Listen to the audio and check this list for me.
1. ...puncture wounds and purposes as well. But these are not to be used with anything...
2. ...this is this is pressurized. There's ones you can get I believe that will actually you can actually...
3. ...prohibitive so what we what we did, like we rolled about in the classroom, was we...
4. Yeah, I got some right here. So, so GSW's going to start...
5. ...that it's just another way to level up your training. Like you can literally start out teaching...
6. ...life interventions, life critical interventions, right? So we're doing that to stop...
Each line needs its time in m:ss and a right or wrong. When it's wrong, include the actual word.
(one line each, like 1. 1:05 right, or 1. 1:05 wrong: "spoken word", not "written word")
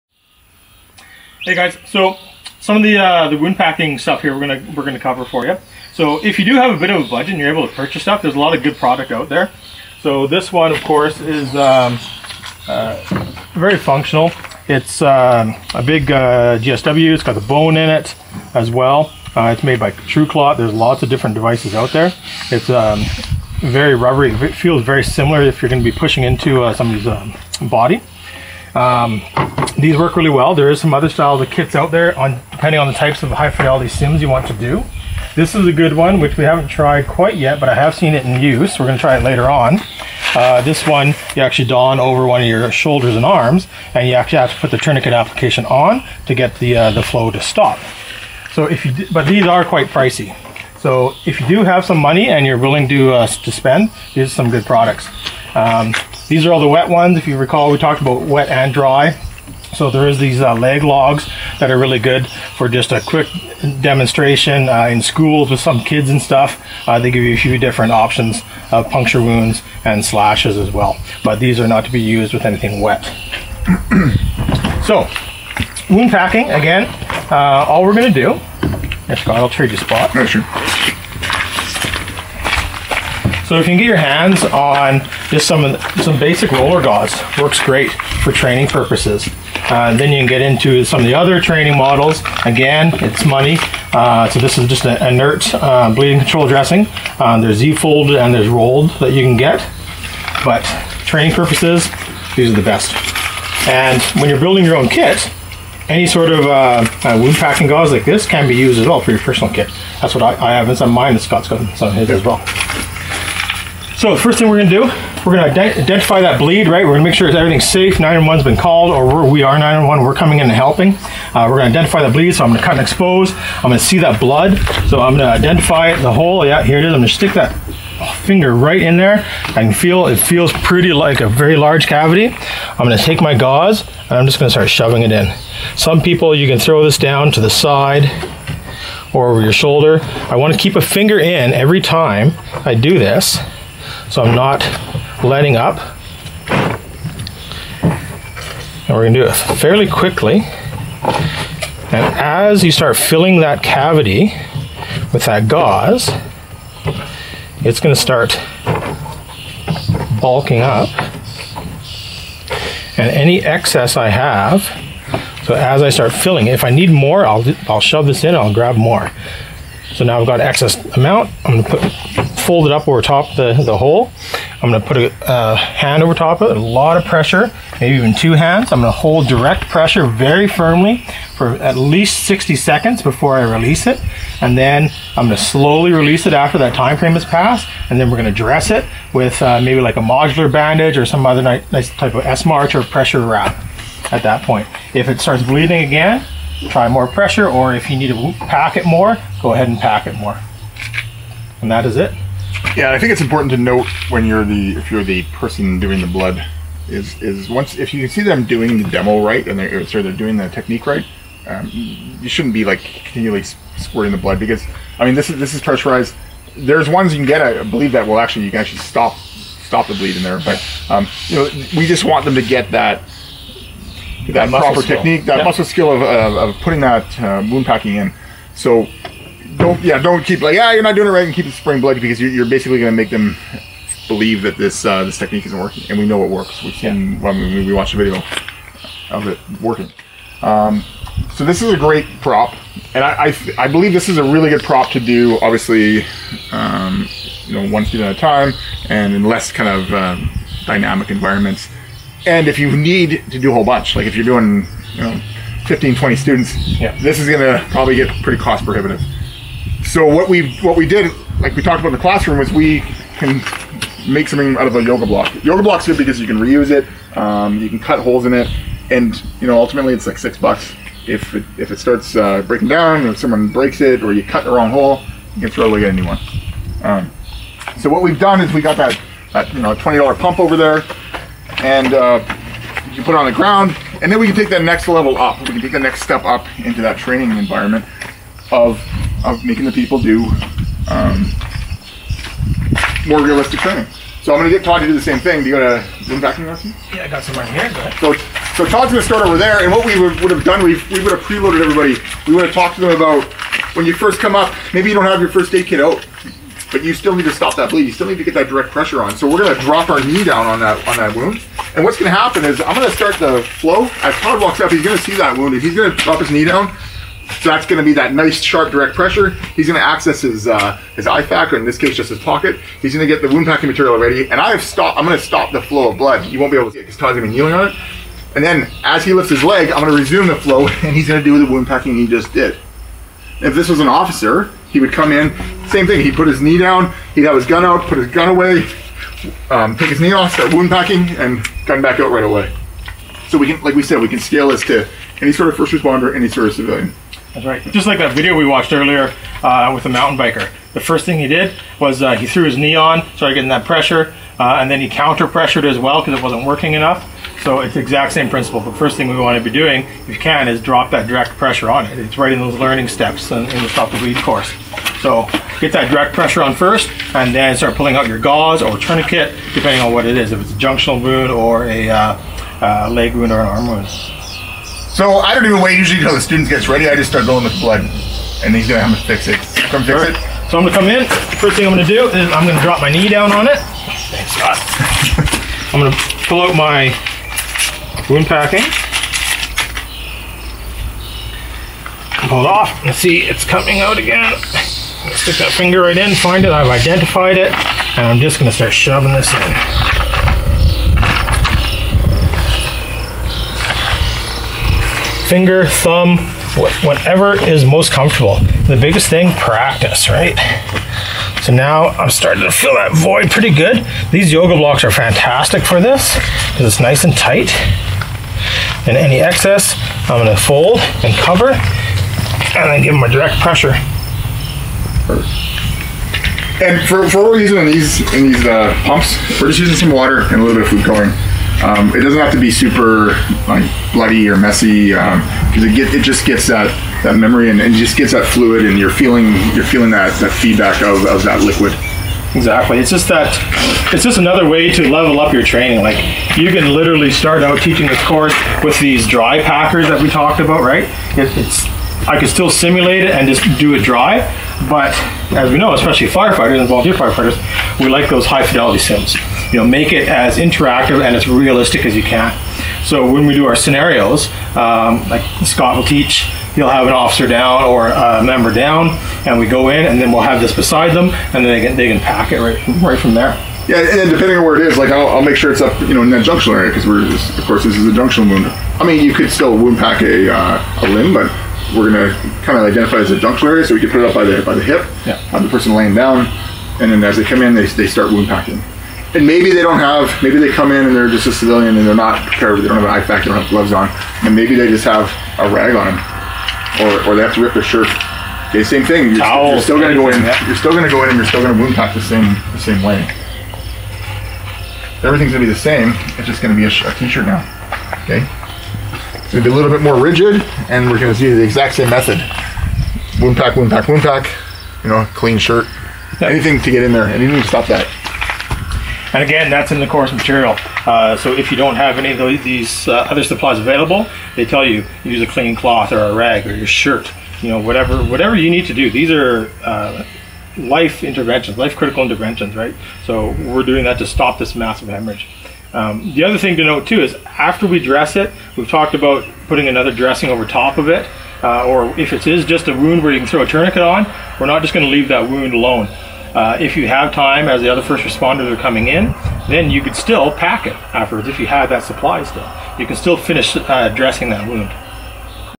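1. 1:08 wrong: "slashes", not "purposes"
2. 3:35 right
3. 4:18 wrong: "talked", not "rolled"
4. 4:56 wrong: "Todd", not "GSW"
5. 7:23 right
6. 8:50 right.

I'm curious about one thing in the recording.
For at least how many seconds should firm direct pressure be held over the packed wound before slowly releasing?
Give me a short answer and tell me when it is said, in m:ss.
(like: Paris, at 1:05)
60, at 3:02.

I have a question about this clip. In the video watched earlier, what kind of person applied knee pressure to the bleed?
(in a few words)
mountain biker.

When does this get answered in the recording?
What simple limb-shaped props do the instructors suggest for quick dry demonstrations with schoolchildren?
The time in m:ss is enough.
1:00.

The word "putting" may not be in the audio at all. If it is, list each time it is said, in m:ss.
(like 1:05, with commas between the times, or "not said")
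3:46, 8:59.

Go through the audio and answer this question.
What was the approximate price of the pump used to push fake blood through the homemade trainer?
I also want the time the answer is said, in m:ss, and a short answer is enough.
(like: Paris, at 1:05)
20 dollars, at 4:39.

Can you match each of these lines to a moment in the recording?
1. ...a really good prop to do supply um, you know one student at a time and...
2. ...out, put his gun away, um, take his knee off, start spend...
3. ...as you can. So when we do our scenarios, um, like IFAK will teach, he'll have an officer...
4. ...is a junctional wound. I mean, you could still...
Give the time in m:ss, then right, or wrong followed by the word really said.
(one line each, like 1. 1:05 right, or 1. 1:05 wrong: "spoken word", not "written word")
1. 4:04 wrong: "obviously", not "supply"
2. 5:37 wrong: "wound", not "spend"
3. 7:41 wrong: "Scott", not "IFAK"
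4. 7:57 right.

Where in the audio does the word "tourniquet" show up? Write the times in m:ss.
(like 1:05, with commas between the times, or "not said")
0:44, 6:08, 9:03.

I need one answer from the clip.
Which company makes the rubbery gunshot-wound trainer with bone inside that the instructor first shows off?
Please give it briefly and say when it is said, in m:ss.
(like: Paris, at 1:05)
TrueClot, at 0:19.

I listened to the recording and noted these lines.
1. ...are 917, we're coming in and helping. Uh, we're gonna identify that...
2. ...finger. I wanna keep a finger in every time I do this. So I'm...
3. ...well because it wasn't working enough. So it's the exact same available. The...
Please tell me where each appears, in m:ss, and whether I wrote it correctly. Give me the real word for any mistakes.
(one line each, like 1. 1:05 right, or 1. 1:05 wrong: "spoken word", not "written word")
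1. 1:59 wrong: "911", not "917"
2. 2:19 wrong: "shoulder", not "finger"
3. 5:55 wrong: "principle", not "available".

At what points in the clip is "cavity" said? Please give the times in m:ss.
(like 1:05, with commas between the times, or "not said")
2:11, 2:33.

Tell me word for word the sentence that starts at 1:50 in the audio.
That's what I, I have in some mine that Scott's got some his as well.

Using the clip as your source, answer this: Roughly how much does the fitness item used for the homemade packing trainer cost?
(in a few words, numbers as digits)
6 dollars.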